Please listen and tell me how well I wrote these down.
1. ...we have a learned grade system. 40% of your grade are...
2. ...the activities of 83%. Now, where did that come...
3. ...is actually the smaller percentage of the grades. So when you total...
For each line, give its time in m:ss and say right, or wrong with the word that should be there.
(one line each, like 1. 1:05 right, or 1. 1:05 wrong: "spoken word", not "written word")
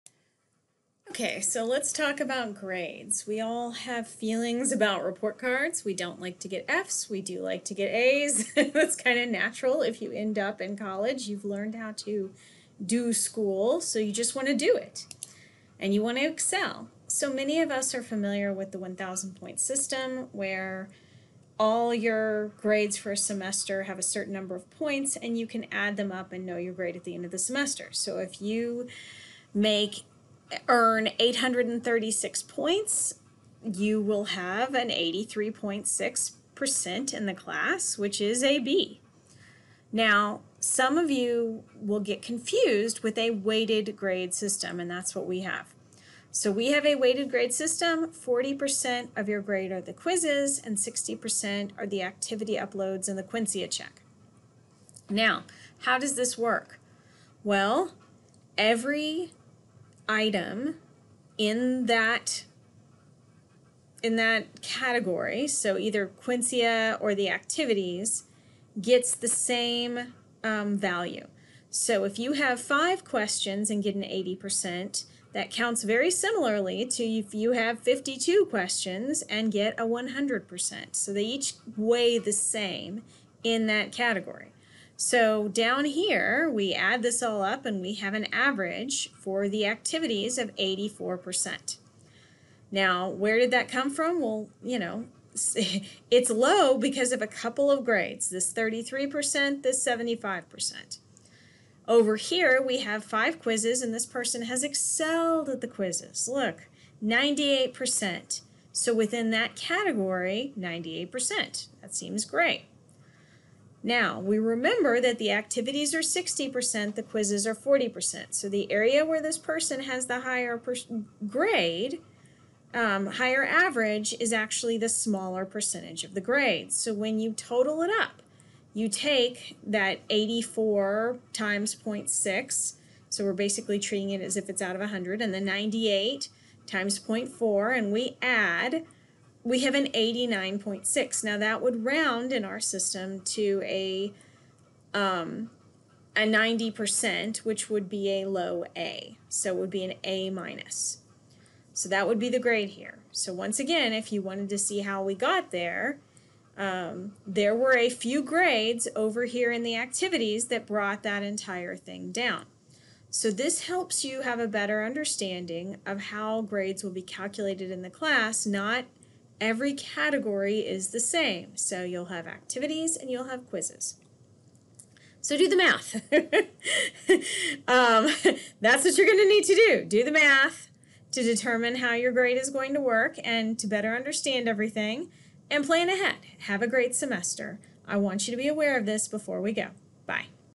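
1. 0:46 wrong: "weighted", not "learned"
2. 1:29 wrong: "84", not "83"
3. 2:04 right.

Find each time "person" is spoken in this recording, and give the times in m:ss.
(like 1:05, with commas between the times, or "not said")
1:44, 1:59.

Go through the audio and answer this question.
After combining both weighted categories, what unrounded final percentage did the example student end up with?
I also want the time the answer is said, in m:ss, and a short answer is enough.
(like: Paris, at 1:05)
89.6, at 2:19.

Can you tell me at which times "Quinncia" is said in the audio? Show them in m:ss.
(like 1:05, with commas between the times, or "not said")
0:53, 1:06.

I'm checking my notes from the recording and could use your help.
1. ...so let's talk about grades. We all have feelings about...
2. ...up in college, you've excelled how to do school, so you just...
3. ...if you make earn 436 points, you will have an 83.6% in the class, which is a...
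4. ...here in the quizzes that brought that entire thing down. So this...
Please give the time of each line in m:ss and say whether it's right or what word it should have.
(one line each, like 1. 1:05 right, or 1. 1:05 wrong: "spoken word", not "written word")
1. 0:01 right
2. 0:10 wrong: "learned", not "excelled"
3. 0:28 wrong: "836", not "436"
4. 2:39 wrong: "activities", not "quizzes".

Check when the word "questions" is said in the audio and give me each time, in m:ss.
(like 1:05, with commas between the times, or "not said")
1:13, 1:18.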